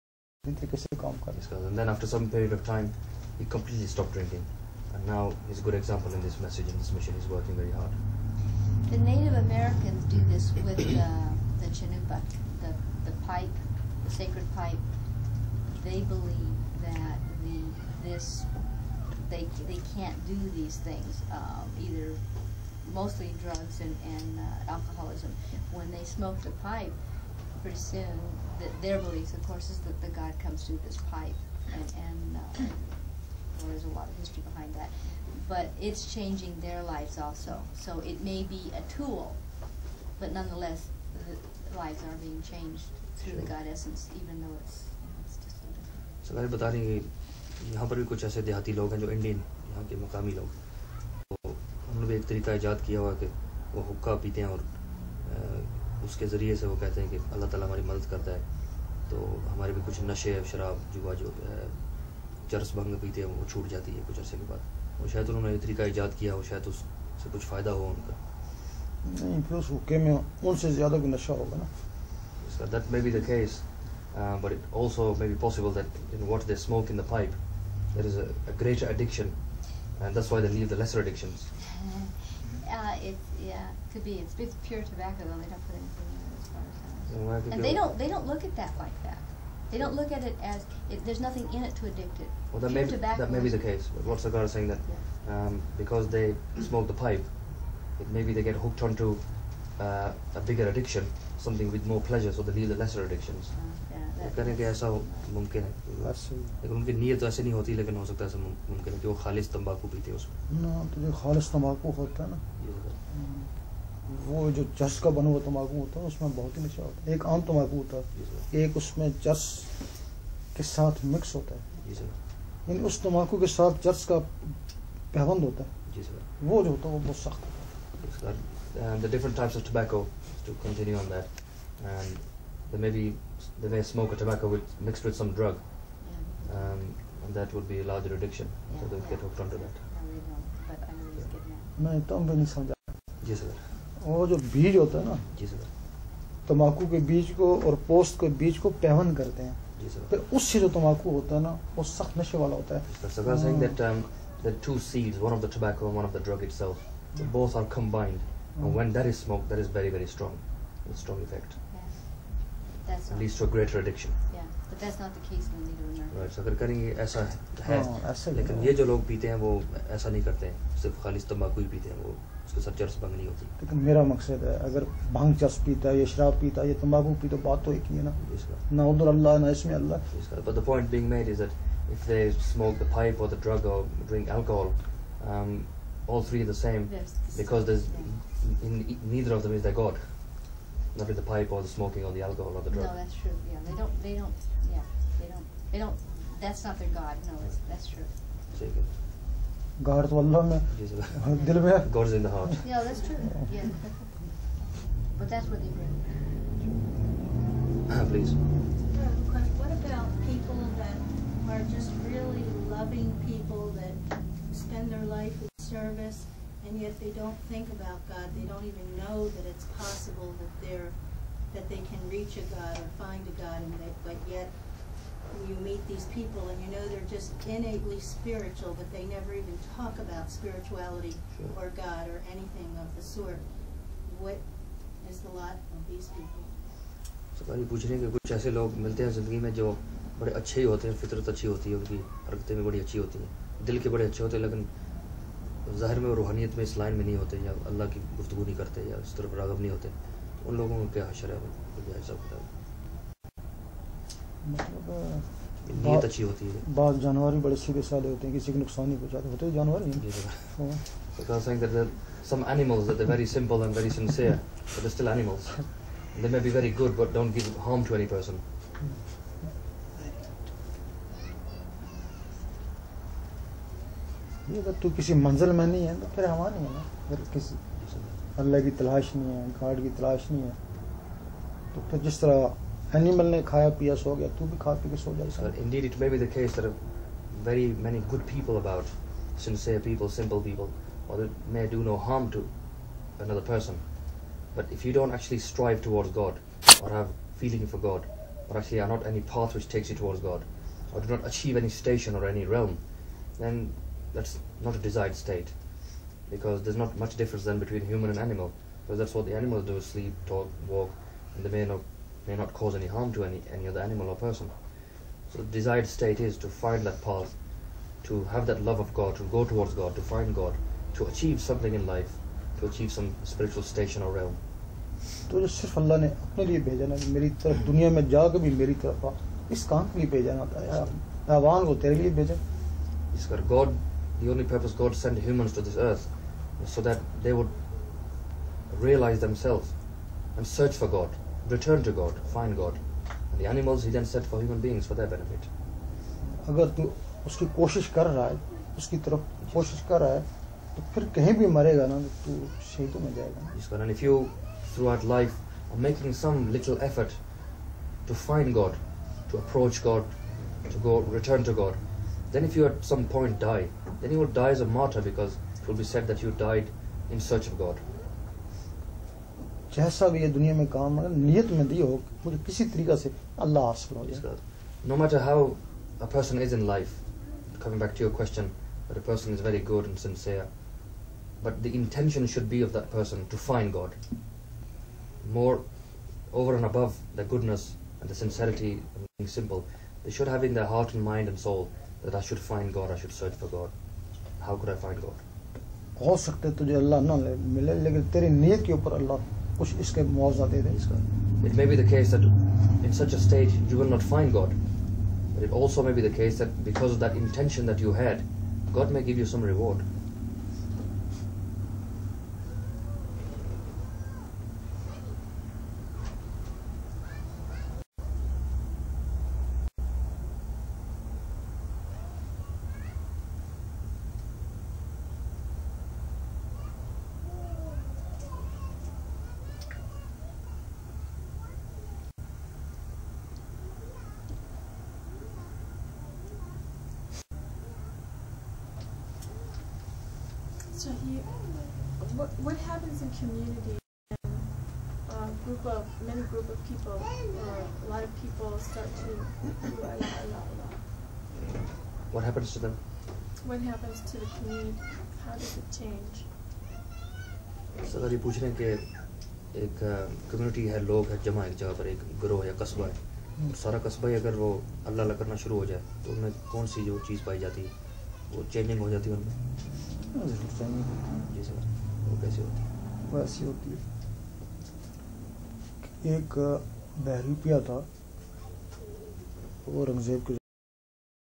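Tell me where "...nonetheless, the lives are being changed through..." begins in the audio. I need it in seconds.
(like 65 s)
40 s.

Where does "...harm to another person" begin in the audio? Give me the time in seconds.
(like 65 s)
292 s.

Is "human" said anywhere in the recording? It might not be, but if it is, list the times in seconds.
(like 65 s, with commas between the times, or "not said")
307 s, 335 s, 344 s.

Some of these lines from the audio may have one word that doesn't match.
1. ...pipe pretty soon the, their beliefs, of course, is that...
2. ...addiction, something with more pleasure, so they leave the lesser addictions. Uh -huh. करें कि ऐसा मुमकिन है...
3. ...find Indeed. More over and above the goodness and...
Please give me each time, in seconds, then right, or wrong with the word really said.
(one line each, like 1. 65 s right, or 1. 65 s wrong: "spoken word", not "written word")
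1. 26 s right
2. 100 s right
3. 383 s wrong: "God", not "Indeed".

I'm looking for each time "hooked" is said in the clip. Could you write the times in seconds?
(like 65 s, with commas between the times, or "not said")
98 s, 139 s.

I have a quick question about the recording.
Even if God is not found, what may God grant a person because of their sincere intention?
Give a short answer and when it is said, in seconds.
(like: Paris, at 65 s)
some reward, at 409 s.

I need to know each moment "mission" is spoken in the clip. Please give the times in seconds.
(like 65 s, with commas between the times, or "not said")
6 s.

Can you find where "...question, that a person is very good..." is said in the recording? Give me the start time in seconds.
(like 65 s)
378 s.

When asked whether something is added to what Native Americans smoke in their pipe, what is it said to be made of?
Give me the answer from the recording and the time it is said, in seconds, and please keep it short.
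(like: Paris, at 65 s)
pure tobacco, at 84 s.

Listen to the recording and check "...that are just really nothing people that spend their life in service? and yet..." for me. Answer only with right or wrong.
wrong.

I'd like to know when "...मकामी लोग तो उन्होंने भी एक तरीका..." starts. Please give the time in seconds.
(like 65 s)
50 s.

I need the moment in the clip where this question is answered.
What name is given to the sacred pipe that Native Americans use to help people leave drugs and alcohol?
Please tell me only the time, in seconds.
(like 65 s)
11 s.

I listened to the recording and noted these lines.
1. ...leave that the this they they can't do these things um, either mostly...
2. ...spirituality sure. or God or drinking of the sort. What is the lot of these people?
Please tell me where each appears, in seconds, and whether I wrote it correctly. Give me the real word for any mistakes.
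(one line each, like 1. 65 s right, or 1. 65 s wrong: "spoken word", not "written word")
1. 16 s wrong: "believe", not "leave"
2. 230 s wrong: "anything", not "drinking".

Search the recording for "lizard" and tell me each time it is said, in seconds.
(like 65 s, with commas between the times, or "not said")
not said.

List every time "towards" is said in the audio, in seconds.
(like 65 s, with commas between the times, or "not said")
295 s, 300 s, 319 s.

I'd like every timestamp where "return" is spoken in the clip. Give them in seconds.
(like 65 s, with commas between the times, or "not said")
341 s, 360 s.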